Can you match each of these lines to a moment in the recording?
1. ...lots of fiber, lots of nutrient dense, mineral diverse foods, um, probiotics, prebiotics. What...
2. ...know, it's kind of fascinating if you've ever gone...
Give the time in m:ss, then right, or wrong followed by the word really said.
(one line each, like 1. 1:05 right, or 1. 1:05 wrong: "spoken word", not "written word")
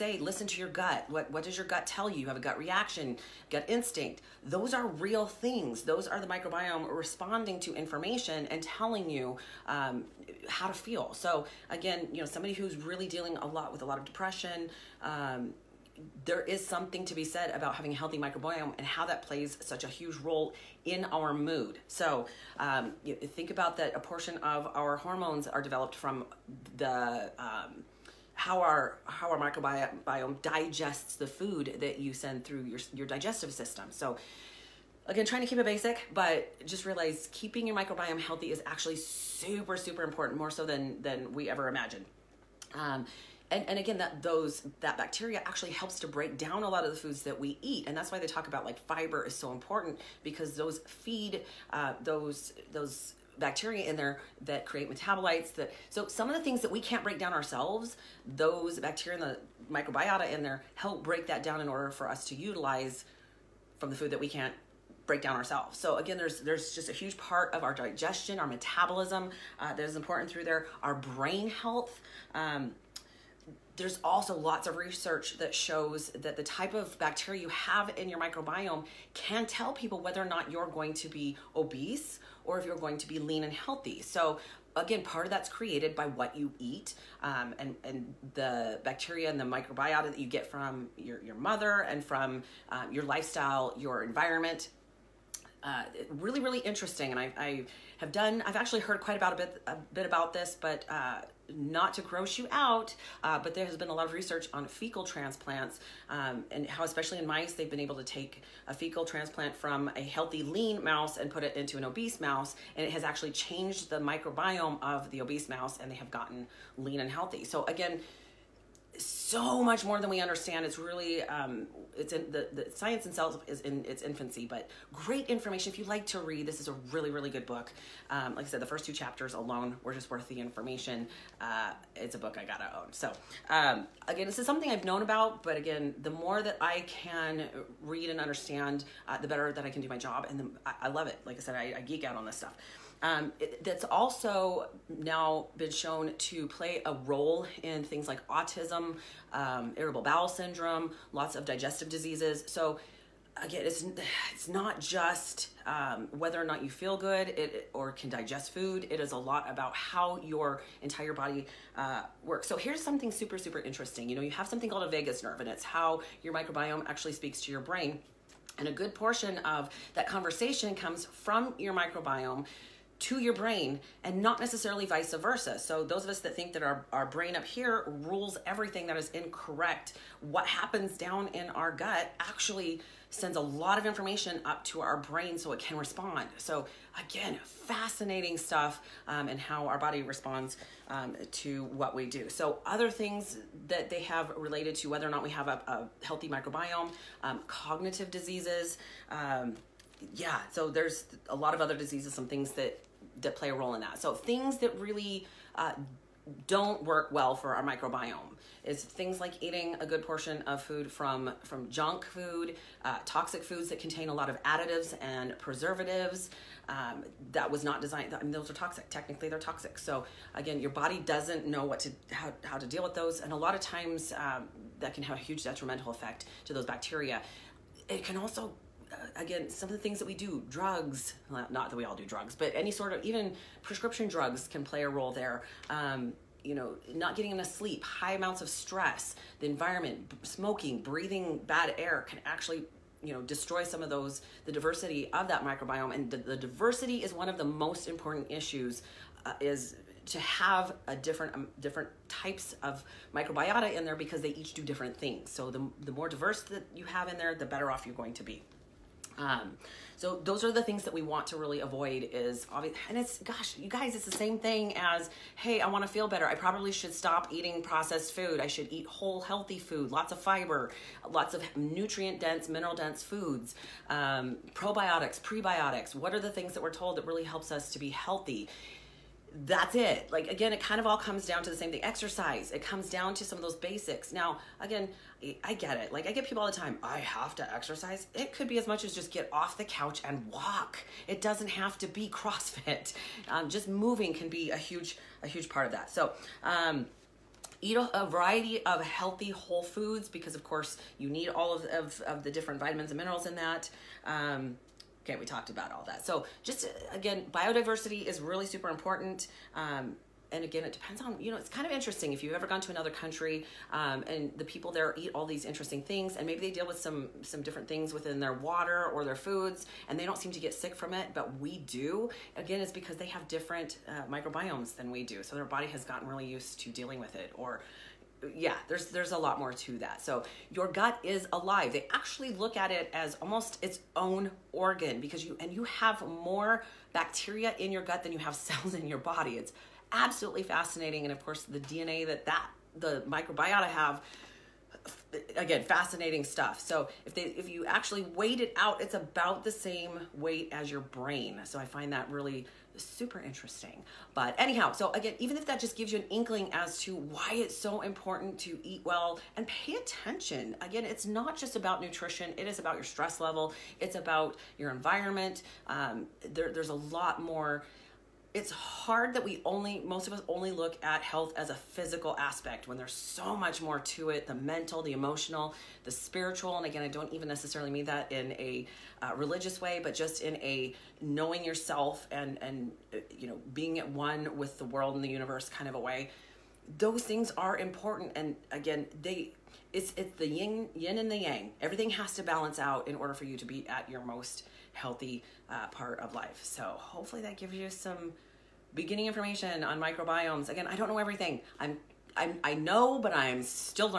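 1. 4:29 wrong: "dense", not "diverse"
2. 5:11 wrong: "interesting", not "fascinating".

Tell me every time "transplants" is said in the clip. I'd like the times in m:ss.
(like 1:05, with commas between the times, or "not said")
1:45, 1:49.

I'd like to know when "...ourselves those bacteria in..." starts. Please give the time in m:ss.
0:57.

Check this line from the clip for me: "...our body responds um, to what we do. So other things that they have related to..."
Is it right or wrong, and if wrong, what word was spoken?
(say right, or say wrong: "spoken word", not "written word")
right.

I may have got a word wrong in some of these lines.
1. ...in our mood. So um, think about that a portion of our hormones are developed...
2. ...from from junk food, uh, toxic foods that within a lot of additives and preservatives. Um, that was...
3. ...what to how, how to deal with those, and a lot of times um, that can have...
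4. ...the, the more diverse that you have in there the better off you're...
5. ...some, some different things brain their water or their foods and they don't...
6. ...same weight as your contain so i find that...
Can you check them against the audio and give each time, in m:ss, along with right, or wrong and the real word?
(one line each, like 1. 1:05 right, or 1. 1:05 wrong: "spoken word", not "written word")
1. 0:20 right
2. 3:30 wrong: "contain", not "within"
3. 3:41 right
4. 4:15 right
5. 5:16 wrong: "within", not "brain"
6. 5:49 wrong: "brain", not "contain".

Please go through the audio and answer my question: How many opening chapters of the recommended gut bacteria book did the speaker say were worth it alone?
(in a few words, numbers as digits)
2.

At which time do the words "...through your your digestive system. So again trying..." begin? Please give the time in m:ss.
0:32.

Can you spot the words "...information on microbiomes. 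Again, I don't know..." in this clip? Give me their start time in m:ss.
6:39.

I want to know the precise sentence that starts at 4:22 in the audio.
And it's, gosh, you guys, it's the same thing as, hey, I want to feel better.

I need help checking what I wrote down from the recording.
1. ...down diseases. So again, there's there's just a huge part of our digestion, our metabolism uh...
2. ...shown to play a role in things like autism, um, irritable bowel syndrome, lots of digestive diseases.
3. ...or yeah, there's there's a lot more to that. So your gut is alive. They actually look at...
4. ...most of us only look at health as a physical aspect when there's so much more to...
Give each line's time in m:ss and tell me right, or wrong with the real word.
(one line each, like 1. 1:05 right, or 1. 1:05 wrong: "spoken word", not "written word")
1. 1:05 wrong: "ourselves", not "diseases"
2. 2:25 right
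3. 5:27 right
4. 6:09 right.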